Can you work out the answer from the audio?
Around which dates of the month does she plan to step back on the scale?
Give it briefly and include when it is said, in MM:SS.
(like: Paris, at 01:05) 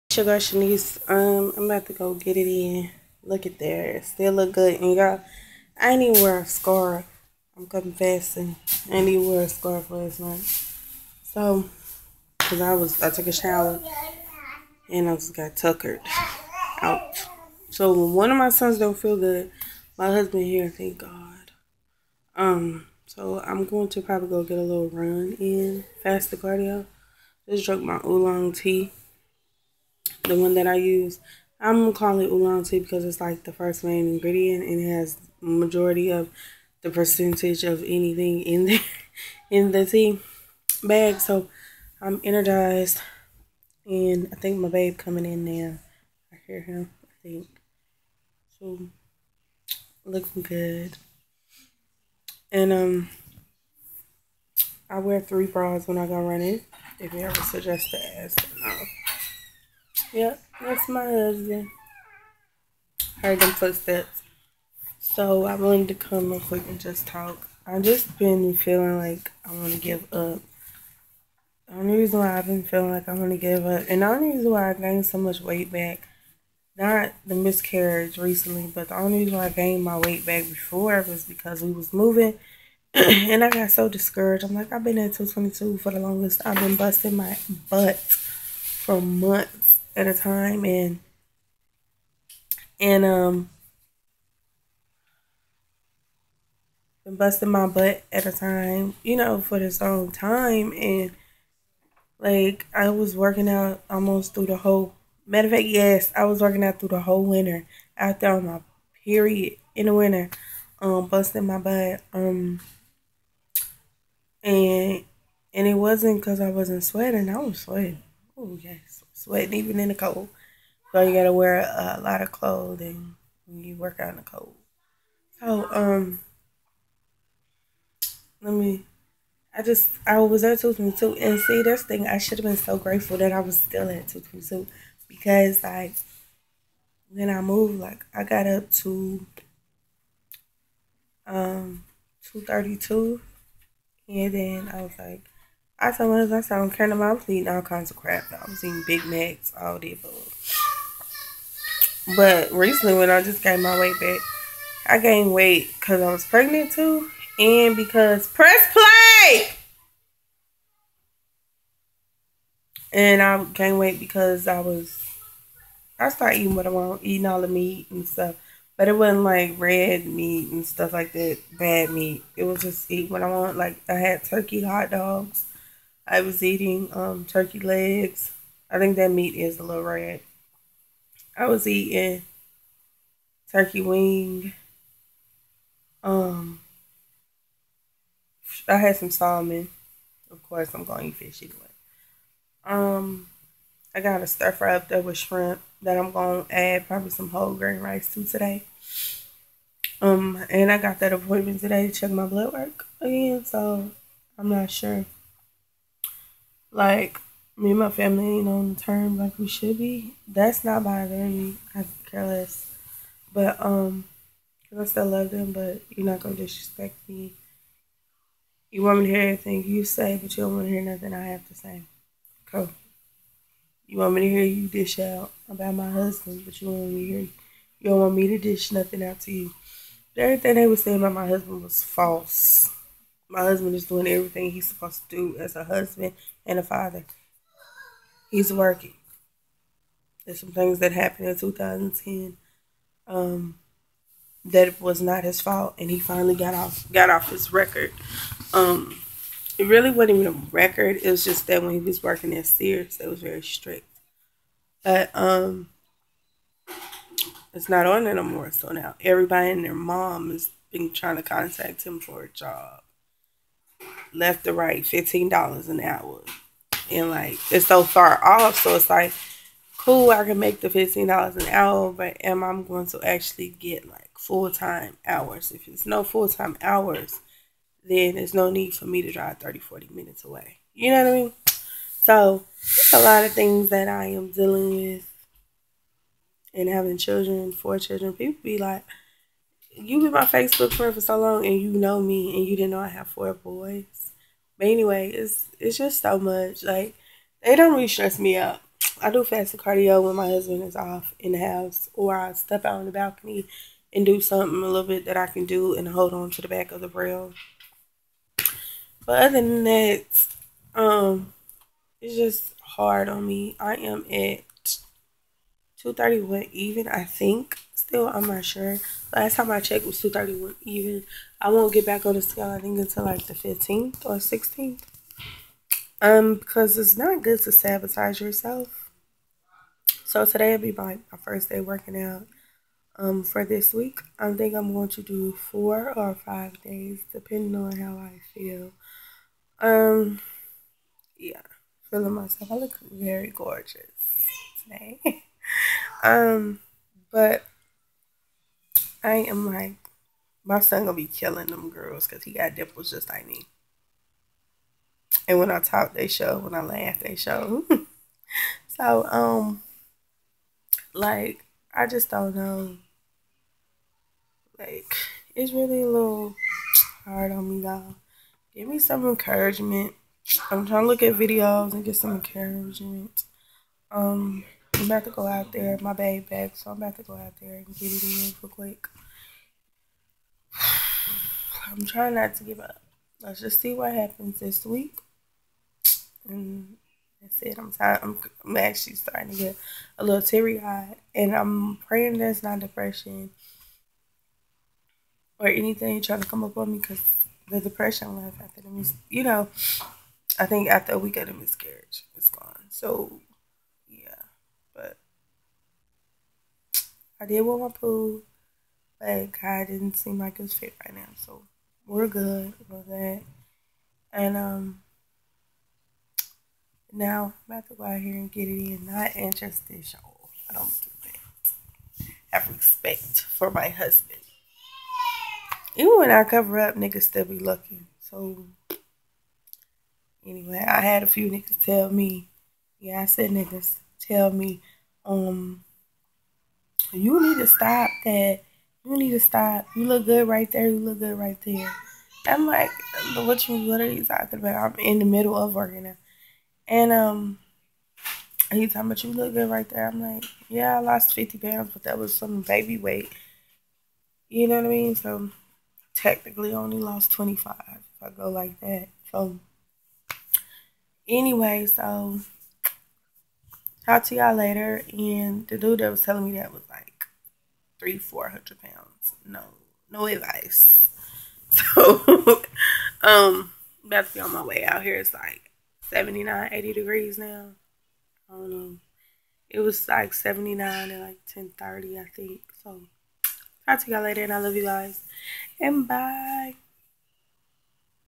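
15th or 16th, at 05:23.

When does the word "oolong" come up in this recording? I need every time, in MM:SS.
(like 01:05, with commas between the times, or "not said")
00:28, 00:32.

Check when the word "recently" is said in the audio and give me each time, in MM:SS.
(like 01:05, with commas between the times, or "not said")
01:18, 02:32.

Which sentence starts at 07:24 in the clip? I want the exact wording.
I'm in the middle of working now.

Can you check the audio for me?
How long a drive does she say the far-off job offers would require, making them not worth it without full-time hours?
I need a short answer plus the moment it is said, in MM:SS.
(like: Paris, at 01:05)
30-40 minutes, at 04:39.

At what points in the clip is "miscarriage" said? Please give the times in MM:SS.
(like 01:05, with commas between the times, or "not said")
01:17, 06:41.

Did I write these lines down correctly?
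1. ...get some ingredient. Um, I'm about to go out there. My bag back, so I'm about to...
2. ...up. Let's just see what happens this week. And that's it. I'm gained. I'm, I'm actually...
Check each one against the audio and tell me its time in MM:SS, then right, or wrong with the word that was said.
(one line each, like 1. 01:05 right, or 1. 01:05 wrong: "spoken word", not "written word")
1. 06:11 wrong: "encouragement", not "ingredient"
2. 06:22 wrong: "tired", not "gained".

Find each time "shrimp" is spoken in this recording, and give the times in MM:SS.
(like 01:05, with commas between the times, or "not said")
03:15.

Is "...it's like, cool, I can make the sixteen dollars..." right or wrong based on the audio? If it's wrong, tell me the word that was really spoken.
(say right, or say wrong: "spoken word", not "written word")
wrong: "fifteen", not "sixteen".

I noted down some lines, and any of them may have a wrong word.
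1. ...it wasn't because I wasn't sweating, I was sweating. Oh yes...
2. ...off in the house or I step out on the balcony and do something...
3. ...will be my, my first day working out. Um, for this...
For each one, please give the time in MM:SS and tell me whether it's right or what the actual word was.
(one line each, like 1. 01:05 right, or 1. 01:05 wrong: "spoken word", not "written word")
1. 01:55 right
2. 05:00 right
3. 05:30 right.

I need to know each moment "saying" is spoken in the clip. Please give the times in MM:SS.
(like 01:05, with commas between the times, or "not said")
03:50.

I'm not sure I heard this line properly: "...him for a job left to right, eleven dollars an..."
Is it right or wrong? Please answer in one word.
wrong.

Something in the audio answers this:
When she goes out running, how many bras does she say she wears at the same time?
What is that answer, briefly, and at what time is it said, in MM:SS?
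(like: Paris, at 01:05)
3, at 00:55.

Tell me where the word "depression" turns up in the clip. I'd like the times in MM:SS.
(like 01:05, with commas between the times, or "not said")
06:32, 06:37.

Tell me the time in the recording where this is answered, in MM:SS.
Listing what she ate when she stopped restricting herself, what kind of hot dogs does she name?
02:54.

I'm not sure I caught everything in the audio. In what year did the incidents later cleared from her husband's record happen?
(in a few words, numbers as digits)
2010.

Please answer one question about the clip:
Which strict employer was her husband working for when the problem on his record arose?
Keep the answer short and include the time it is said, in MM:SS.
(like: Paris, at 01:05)
Sears, at 04:12.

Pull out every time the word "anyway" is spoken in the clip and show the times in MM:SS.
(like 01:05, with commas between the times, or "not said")
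03:11, 04:54, 07:10, 07:41.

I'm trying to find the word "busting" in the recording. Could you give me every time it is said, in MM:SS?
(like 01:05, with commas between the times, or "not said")
01:26, 01:37, 01:51.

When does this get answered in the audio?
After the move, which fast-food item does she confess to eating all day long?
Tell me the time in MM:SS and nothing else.
02:28.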